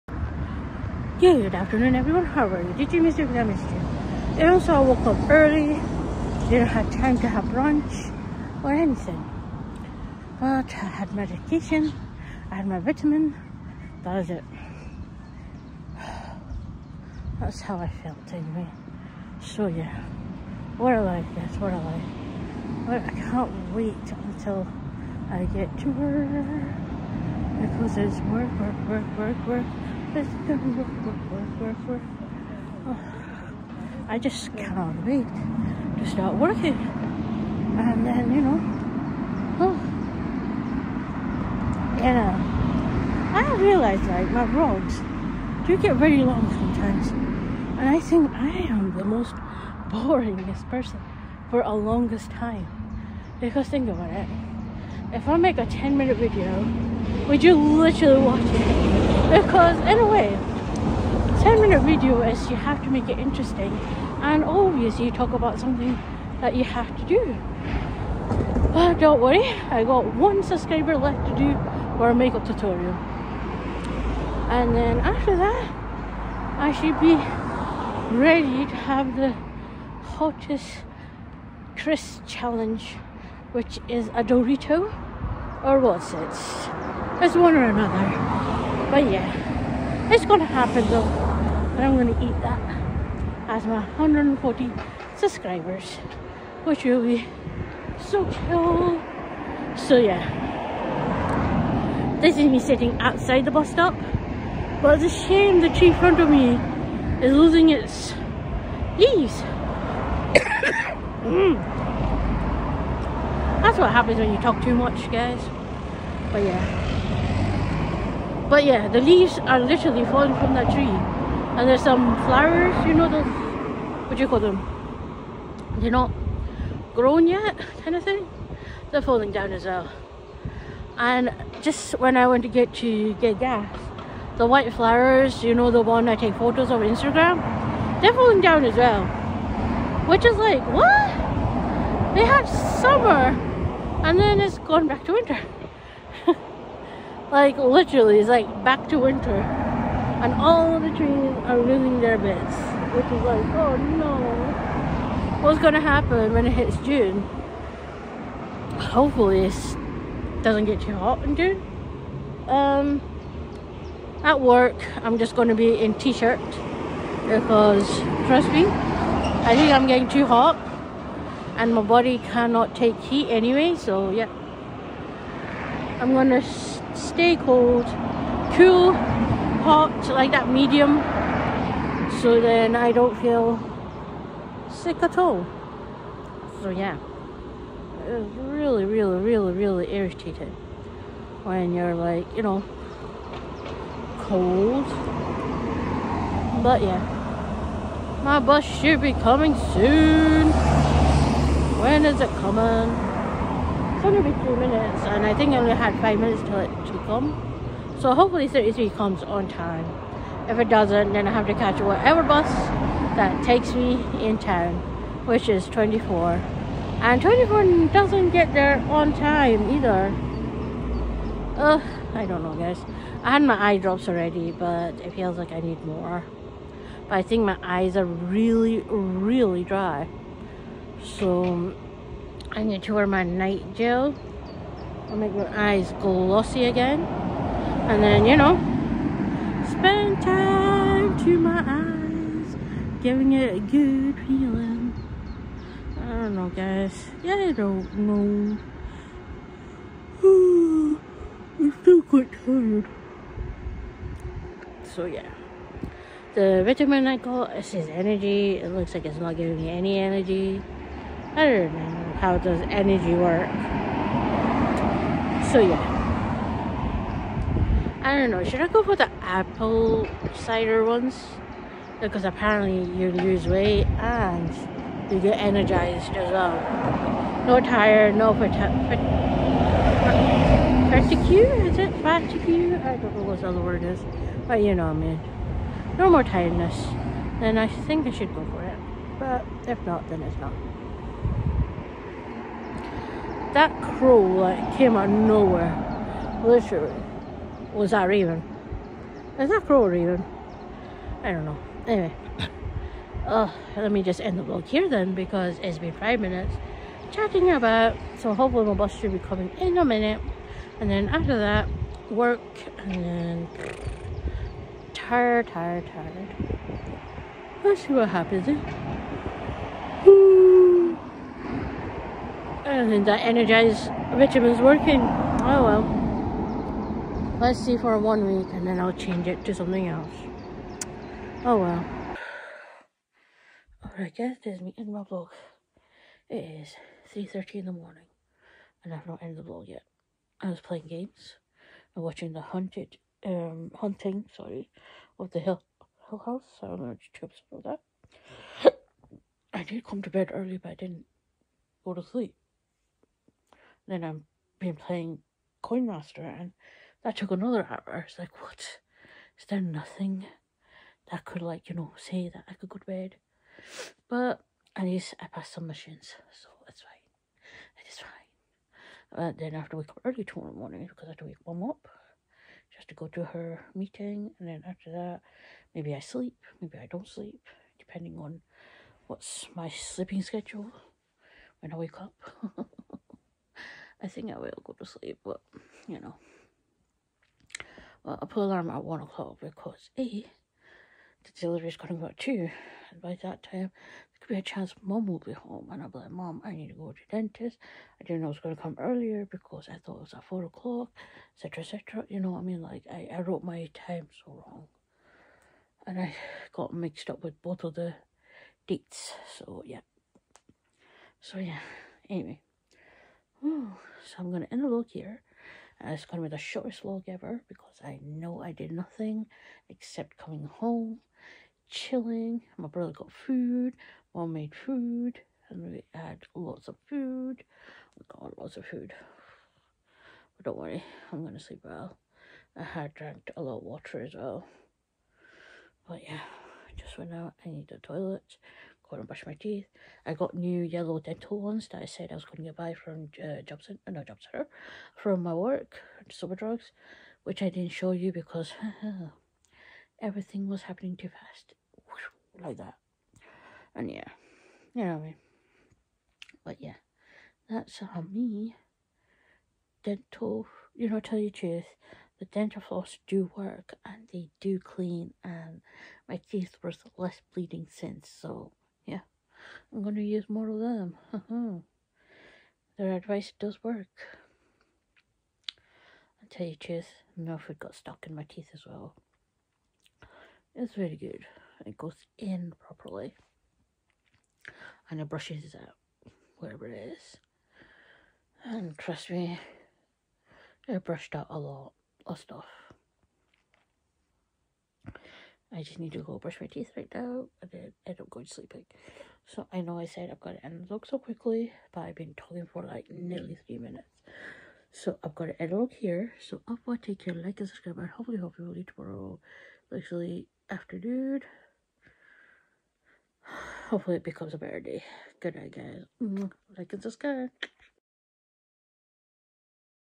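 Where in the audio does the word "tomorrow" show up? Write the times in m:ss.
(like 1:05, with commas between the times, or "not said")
6:10, 8:28.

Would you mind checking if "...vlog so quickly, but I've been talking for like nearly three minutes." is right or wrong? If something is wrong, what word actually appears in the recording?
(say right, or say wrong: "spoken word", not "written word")
right.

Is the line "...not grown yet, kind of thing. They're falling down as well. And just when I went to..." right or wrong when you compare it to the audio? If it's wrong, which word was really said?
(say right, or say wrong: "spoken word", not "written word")
right.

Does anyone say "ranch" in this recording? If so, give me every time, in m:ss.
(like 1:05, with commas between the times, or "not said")
not said.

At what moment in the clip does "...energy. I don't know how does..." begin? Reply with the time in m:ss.
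4:19.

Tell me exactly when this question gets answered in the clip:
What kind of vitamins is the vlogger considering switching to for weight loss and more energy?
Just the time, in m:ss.
4:29.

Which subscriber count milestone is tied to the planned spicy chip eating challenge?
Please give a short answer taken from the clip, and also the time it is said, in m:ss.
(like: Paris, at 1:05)
140, at 1:33.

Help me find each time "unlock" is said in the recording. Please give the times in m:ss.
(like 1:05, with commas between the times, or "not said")
not said.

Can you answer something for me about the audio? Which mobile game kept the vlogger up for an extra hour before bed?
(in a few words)
Coin Master.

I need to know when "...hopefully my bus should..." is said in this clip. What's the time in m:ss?
5:08.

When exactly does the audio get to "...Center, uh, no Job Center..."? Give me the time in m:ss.
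7:23.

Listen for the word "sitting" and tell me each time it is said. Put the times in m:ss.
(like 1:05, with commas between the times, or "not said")
1:42.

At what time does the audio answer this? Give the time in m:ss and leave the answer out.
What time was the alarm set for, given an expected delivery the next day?
6:28.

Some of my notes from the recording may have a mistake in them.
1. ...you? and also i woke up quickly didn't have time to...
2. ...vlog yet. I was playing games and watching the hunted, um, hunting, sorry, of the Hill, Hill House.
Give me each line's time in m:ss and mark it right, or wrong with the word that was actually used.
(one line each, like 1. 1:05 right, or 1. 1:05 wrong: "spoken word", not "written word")
1. 0:03 wrong: "early", not "quickly"
2. 5:39 right.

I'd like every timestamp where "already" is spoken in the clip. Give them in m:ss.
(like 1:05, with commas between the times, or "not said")
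3:44.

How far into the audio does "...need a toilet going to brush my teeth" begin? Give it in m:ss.
7:17.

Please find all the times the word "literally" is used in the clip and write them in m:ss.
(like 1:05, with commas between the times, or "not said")
0:57, 1:59, 2:27, 4:56, 8:29.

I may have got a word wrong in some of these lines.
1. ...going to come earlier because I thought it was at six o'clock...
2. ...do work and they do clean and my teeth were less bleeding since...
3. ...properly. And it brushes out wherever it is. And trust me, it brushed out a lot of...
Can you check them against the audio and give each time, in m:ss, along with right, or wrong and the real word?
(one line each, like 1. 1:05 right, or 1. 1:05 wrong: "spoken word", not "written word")
1. 6:38 wrong: "four", not "six"
2. 7:43 right
3. 8:02 right.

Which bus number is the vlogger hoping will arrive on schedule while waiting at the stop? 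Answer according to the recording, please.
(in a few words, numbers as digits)
33.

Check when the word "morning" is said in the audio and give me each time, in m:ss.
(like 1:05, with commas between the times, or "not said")
5:37, 6:10.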